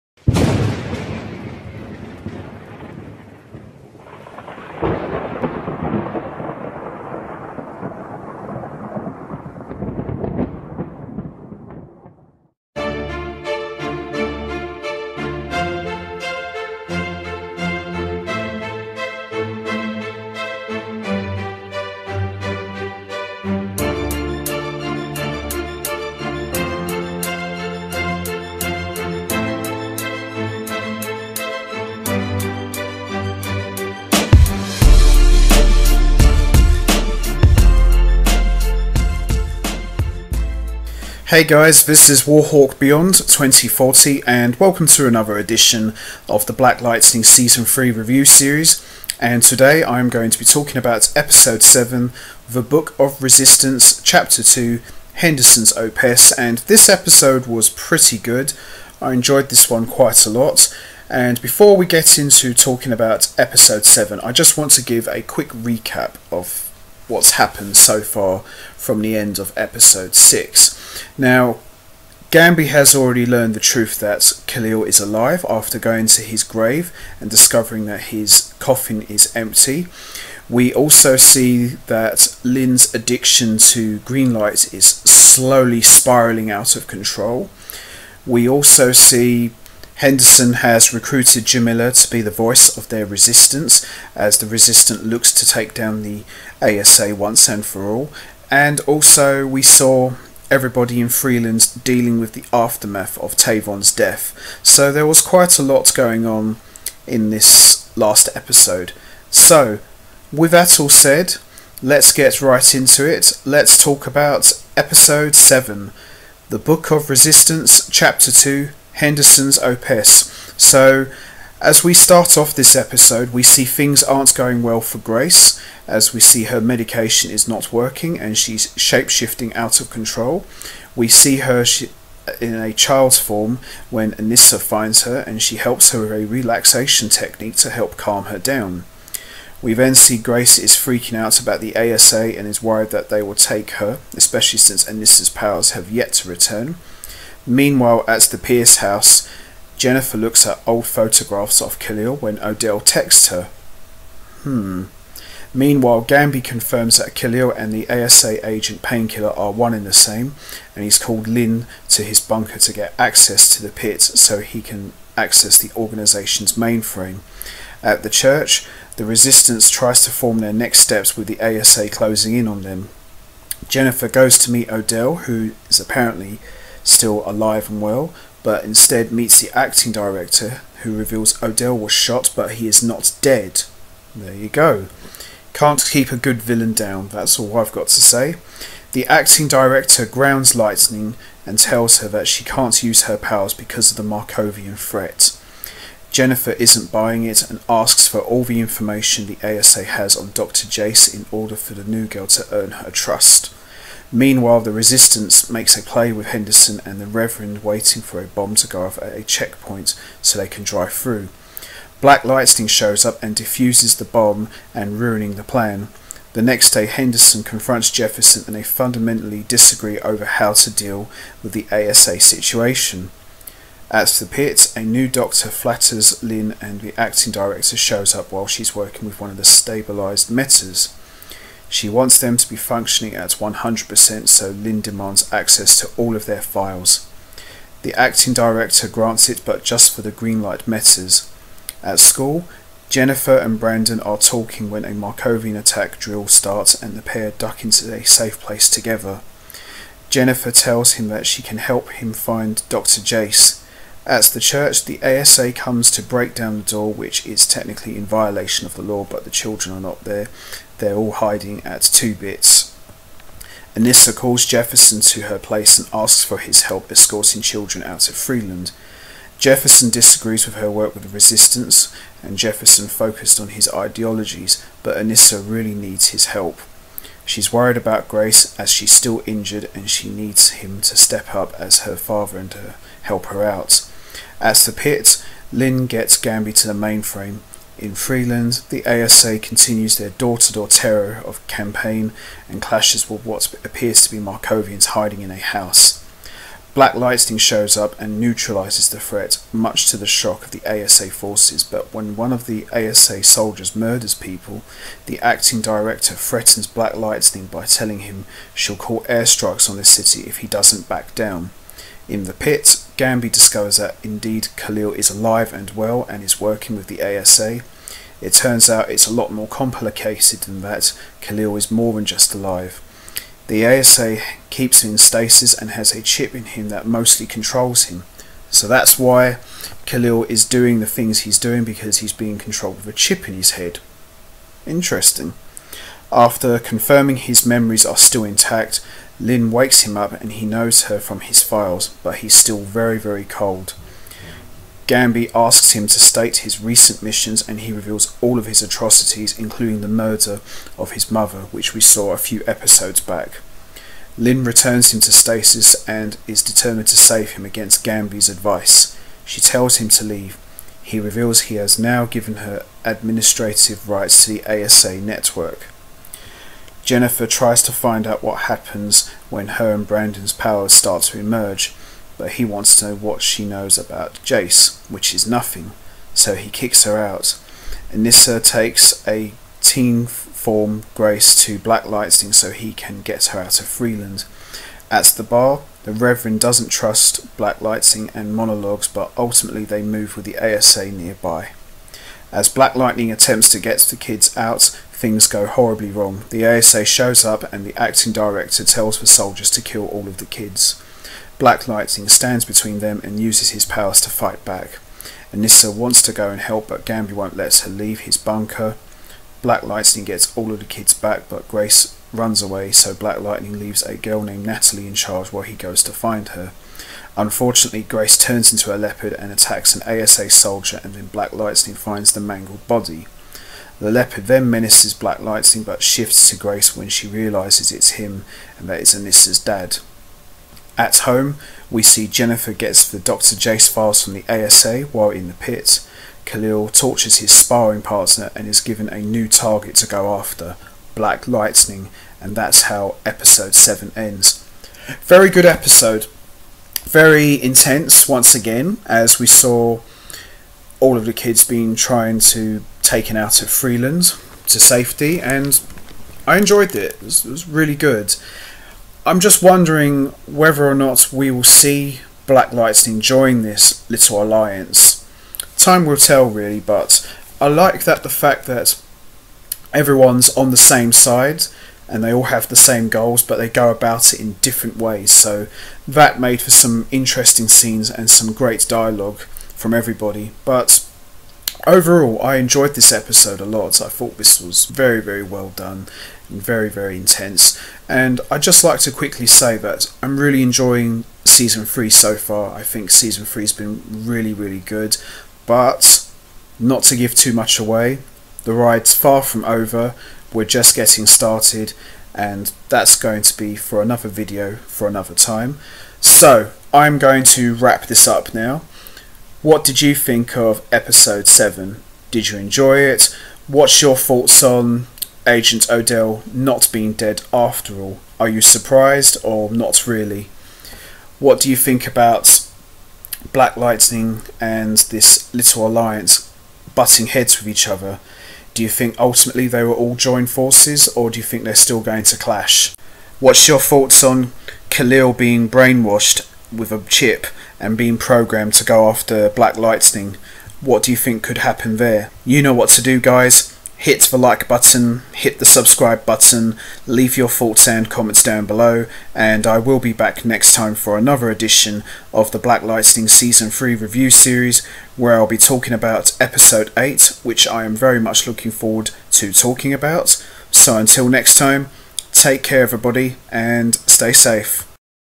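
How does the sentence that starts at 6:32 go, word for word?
As Black Lightning attempts to get the kids out, things go horribly wrong.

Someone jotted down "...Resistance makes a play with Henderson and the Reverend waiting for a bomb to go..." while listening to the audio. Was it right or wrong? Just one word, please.
right.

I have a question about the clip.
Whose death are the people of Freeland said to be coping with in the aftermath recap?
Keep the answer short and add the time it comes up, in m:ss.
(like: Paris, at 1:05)
Tavon, at 1:43.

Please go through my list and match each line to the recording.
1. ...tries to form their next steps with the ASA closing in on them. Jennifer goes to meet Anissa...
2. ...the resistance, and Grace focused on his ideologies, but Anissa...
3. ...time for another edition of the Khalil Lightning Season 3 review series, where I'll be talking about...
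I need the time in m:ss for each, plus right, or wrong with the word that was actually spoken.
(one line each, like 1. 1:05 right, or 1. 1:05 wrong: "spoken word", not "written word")
1. 2:49 wrong: "Odell", not "Anissa"
2. 4:31 wrong: "Jefferson", not "Grace"
3. 9:10 wrong: "Black", not "Khalil".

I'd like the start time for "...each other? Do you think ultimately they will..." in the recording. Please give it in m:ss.
8:47.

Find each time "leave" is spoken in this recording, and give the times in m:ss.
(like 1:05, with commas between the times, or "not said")
6:00, 6:47, 6:53, 9:06.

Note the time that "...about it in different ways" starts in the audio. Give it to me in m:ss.
7:53.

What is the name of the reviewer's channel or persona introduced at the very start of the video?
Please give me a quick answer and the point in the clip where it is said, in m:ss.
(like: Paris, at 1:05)
Warhawk Beyond 2040, at 0:42.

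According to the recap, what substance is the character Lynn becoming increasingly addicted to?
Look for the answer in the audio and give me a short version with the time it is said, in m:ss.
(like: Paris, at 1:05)
green light, at 1:23.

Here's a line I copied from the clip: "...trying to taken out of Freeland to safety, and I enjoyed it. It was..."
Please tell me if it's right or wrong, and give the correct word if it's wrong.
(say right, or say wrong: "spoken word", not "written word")
right.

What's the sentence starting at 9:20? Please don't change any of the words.
So until next time, take care everybody, and stay safe.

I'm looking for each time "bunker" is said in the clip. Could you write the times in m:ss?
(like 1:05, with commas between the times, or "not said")
2:42, 6:48.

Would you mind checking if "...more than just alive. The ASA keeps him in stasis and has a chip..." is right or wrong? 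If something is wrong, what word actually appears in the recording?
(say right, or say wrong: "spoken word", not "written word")
right.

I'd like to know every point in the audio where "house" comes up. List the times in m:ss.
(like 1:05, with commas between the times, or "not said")
2:28, 4:55.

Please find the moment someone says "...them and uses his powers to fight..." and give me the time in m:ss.
6:42.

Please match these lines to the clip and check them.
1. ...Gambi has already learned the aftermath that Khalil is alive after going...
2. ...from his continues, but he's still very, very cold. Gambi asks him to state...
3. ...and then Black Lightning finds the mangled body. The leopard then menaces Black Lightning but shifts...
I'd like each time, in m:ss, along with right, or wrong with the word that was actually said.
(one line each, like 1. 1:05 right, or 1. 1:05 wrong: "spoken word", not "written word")
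1. 1:12 wrong: "truth", not "aftermath"
2. 5:41 wrong: "files", not "continues"
3. 7:00 right.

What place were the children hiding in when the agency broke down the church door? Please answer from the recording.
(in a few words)
Two Bits.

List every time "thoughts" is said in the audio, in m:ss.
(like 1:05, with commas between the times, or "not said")
8:03, 8:33, 8:53, 9:07.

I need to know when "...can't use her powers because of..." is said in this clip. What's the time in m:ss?
3:12.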